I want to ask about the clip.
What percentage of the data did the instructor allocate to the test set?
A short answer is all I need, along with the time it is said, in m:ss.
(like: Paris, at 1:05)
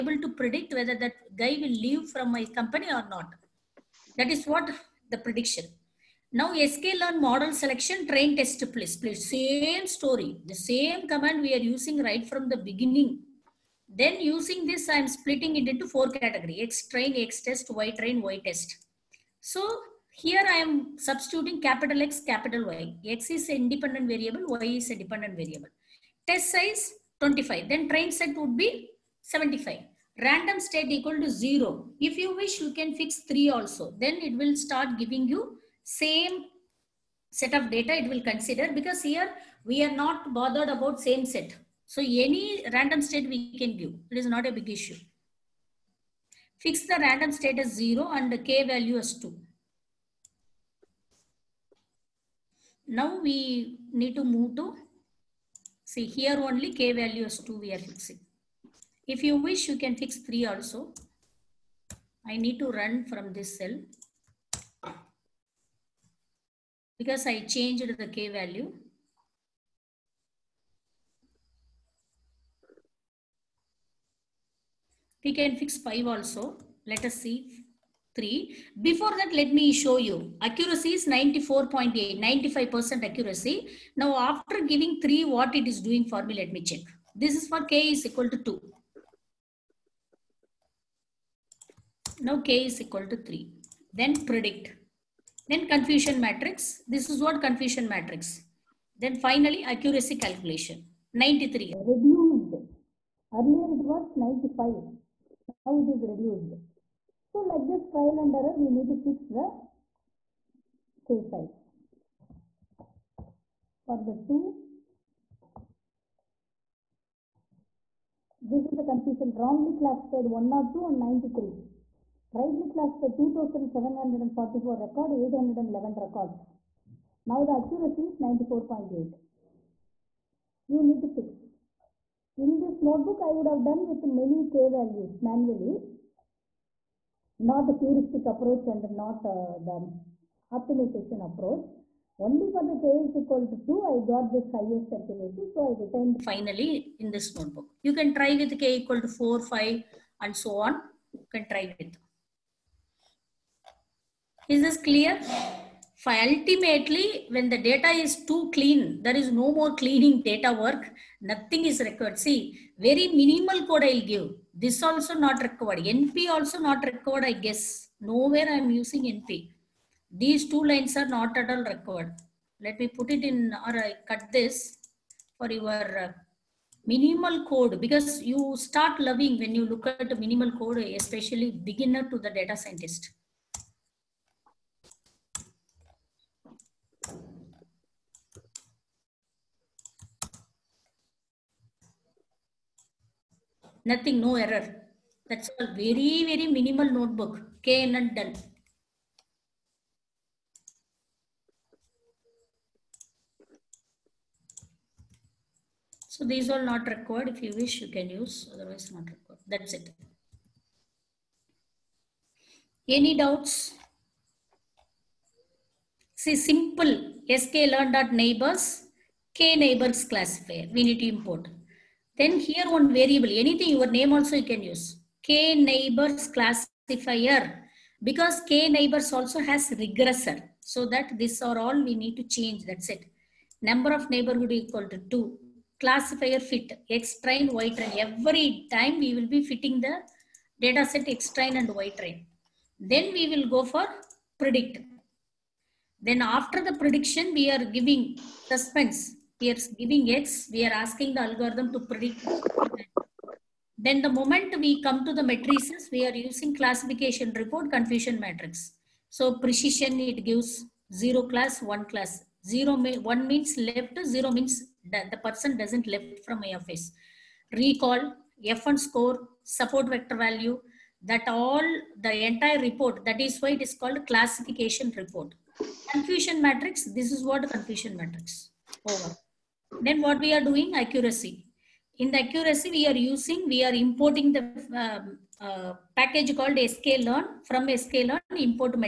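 25, at 0:26.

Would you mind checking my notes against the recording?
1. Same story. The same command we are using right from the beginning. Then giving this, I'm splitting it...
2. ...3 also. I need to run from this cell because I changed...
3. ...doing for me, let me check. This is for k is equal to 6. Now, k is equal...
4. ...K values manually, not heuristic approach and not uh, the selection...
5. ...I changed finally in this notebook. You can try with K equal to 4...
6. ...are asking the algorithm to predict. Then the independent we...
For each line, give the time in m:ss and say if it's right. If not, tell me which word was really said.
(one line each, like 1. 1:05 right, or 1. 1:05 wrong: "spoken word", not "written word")
1. 0:09 wrong: "using", not "giving"
2. 1:00 right
3. 1:25 wrong: "2", not "6"
4. 2:14 wrong: "optimization", not "selection"
5. 2:25 wrong: "retained", not "changed"
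6. 4:10 wrong: "moment", not "independent".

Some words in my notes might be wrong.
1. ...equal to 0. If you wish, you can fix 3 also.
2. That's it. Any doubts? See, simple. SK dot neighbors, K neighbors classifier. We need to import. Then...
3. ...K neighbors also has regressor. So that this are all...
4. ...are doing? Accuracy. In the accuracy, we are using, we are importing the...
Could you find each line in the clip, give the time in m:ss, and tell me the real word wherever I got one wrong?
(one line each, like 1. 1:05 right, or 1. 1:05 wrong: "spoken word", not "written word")
1. 0:30 right
2. 3:29 right
3. 3:48 right
4. 4:40 right.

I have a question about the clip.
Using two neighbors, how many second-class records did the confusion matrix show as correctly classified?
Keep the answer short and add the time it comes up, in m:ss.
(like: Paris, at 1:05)
811, at 2:05.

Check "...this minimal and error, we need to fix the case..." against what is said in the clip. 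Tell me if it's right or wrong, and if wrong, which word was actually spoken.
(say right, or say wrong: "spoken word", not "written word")
wrong: "trial", not "minimal".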